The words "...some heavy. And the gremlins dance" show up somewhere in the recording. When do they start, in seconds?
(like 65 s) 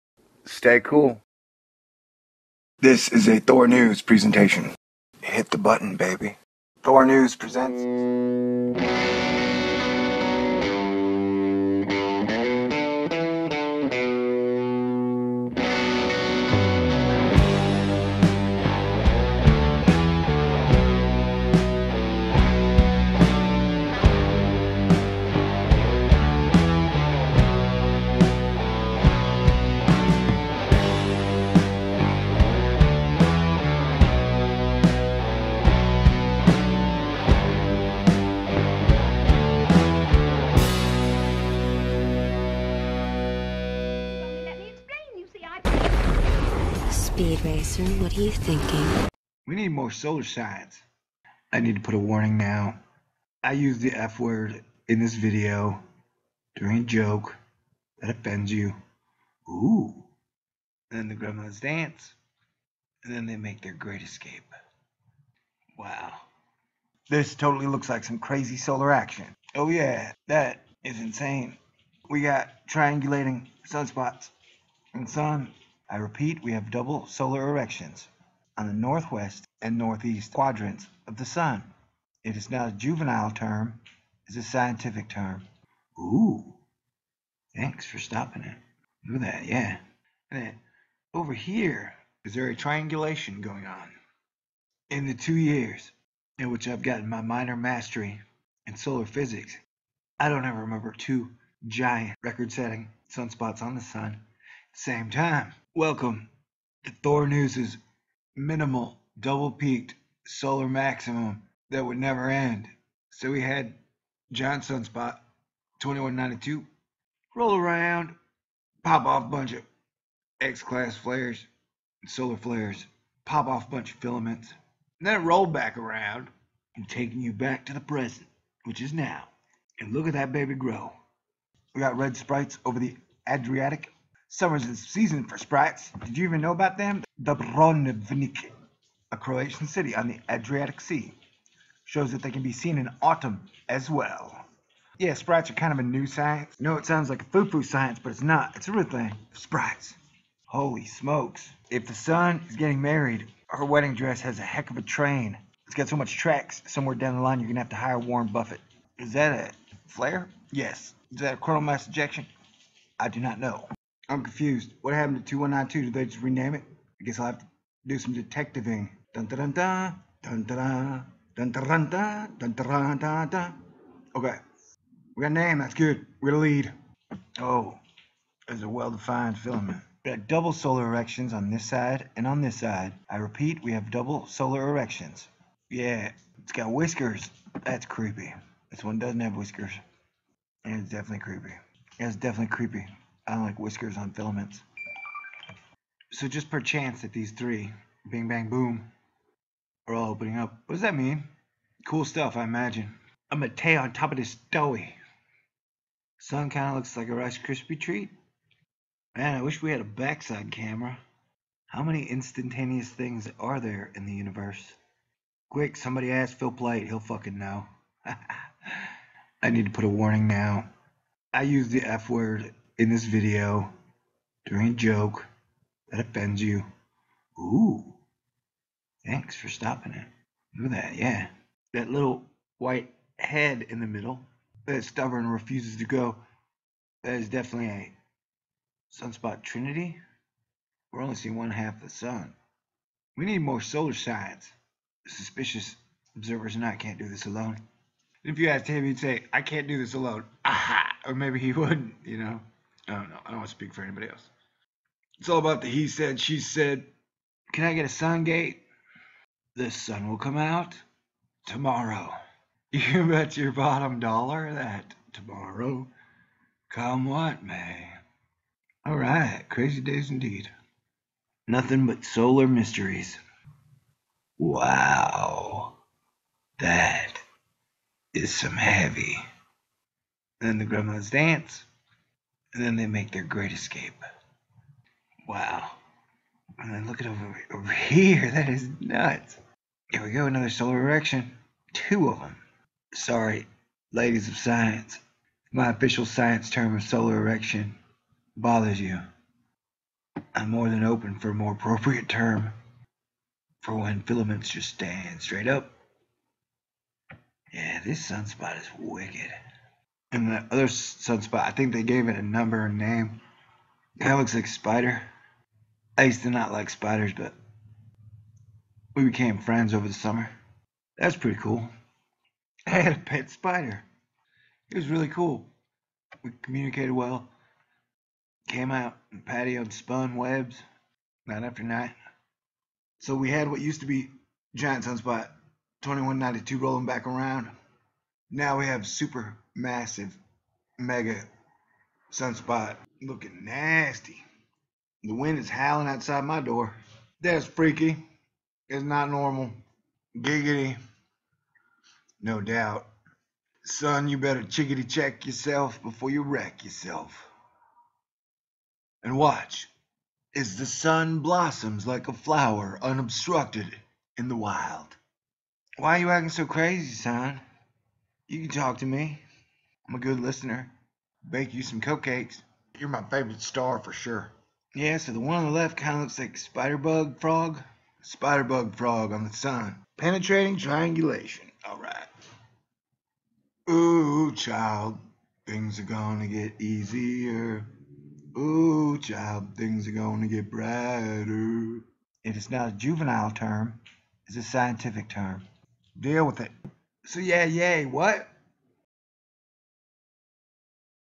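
278 s.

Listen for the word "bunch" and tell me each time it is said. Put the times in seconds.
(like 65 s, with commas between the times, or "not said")
119 s, 123 s.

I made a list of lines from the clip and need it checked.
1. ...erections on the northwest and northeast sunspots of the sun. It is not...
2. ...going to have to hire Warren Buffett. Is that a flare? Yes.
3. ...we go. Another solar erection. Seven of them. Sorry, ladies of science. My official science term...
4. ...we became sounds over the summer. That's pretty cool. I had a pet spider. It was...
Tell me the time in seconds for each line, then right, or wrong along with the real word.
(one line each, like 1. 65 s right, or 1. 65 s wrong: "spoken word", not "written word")
1. 77 s wrong: "quadrants", not "sunspots"
2. 157 s right
3. 290 s wrong: "Two", not "Seven"
4. 318 s wrong: "friends", not "sounds".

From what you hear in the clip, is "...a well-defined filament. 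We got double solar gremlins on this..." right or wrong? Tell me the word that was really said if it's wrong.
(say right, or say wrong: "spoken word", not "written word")
wrong: "erections", not "gremlins".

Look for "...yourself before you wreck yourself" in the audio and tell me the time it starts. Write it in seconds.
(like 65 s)
355 s.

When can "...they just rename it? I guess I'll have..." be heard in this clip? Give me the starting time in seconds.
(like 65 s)
165 s.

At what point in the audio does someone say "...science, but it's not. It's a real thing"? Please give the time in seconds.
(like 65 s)
147 s.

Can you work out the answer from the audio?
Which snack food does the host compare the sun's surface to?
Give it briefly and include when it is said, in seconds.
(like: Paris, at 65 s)
Rice Krispie treat, at 207 s.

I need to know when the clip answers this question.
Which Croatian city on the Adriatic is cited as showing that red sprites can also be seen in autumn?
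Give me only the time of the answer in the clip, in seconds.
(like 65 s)
137 s.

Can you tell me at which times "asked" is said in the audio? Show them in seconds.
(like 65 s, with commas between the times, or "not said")
248 s.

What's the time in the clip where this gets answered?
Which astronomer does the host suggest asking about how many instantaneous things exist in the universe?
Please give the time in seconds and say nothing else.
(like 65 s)
216 s.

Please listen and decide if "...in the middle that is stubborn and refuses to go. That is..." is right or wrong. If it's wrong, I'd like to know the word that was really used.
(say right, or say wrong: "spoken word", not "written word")
right.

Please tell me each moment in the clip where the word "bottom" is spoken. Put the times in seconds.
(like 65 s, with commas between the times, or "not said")
263 s.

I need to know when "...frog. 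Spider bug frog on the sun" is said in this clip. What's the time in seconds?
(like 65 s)
377 s.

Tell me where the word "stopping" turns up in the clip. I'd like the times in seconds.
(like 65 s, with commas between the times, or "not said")
87 s, 229 s.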